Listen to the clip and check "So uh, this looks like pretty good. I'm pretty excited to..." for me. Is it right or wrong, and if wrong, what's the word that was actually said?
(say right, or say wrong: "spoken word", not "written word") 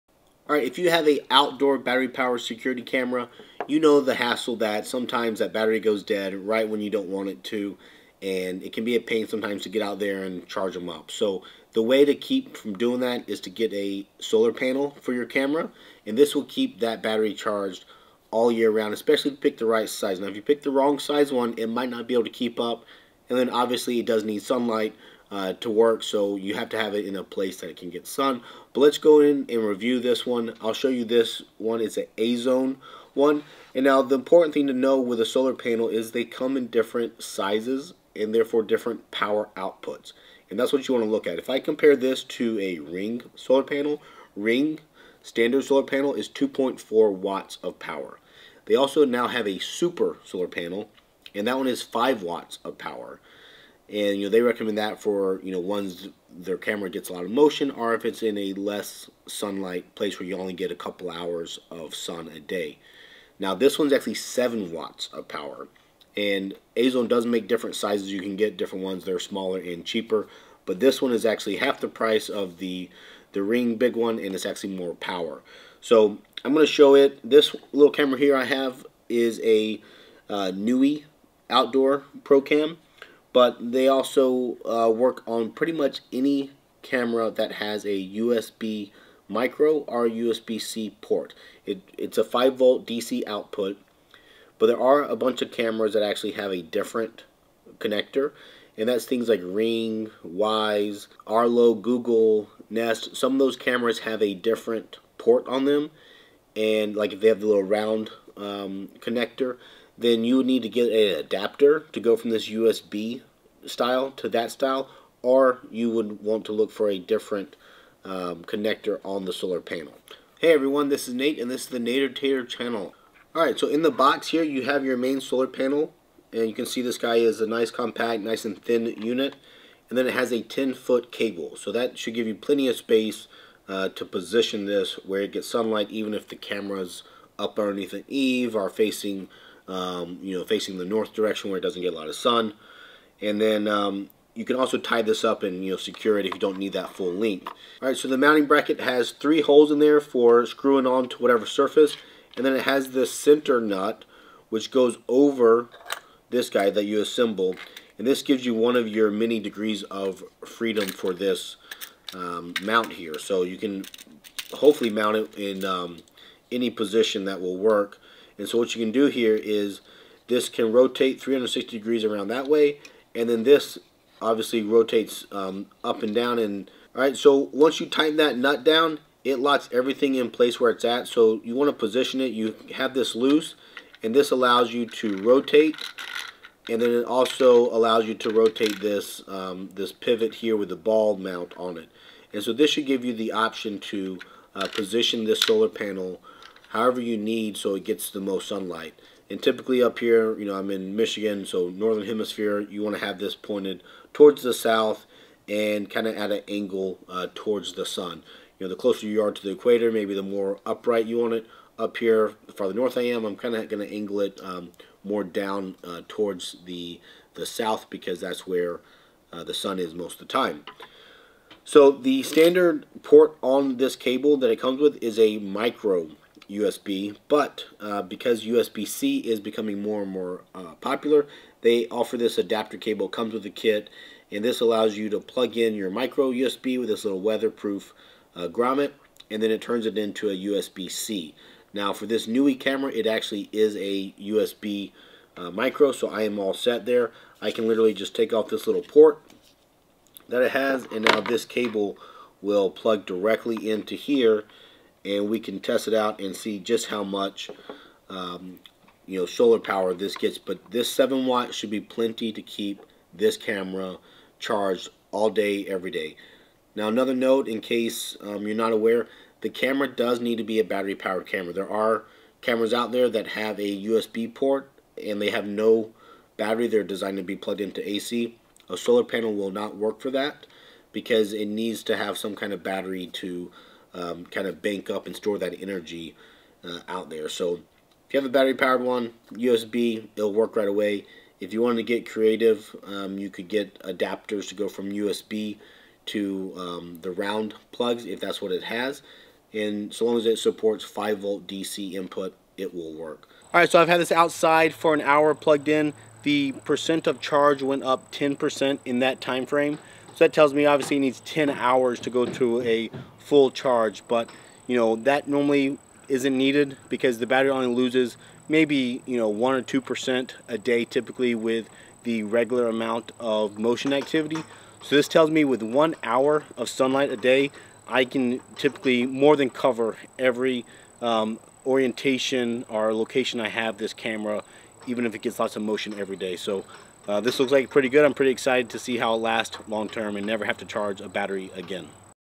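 right.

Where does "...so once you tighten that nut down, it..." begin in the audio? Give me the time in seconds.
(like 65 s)
177 s.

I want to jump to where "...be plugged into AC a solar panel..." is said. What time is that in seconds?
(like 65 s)
277 s.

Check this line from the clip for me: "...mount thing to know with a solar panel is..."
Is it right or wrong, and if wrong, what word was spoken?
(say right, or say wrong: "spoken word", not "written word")
wrong: "important", not "mount".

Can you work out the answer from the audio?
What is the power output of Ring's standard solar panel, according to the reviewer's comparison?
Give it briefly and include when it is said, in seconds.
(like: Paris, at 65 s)
2.4 watts, at 46 s.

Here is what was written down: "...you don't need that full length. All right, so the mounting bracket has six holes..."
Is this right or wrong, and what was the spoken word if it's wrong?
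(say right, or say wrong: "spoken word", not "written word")
wrong: "three", not "six".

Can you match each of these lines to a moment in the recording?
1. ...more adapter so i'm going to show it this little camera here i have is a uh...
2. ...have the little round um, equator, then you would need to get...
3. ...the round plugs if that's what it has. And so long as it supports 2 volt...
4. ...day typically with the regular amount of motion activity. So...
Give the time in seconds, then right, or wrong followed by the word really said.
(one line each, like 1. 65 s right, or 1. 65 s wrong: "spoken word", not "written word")
1. 74 s wrong: "power", not "adapter"
2. 107 s wrong: "connector", not "equator"
3. 297 s wrong: "5", not "2"
4. 320 s right.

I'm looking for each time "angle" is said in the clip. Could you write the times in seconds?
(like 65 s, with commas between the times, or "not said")
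206 s, 213 s.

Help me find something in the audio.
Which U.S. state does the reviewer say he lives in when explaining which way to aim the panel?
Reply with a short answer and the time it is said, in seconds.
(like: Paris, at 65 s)
Michigan, at 200 s.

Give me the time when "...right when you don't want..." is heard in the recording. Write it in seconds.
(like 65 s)
6 s.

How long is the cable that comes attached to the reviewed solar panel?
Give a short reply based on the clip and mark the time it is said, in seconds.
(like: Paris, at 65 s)
10 feet, at 130 s.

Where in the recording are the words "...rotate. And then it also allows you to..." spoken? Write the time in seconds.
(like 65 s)
185 s.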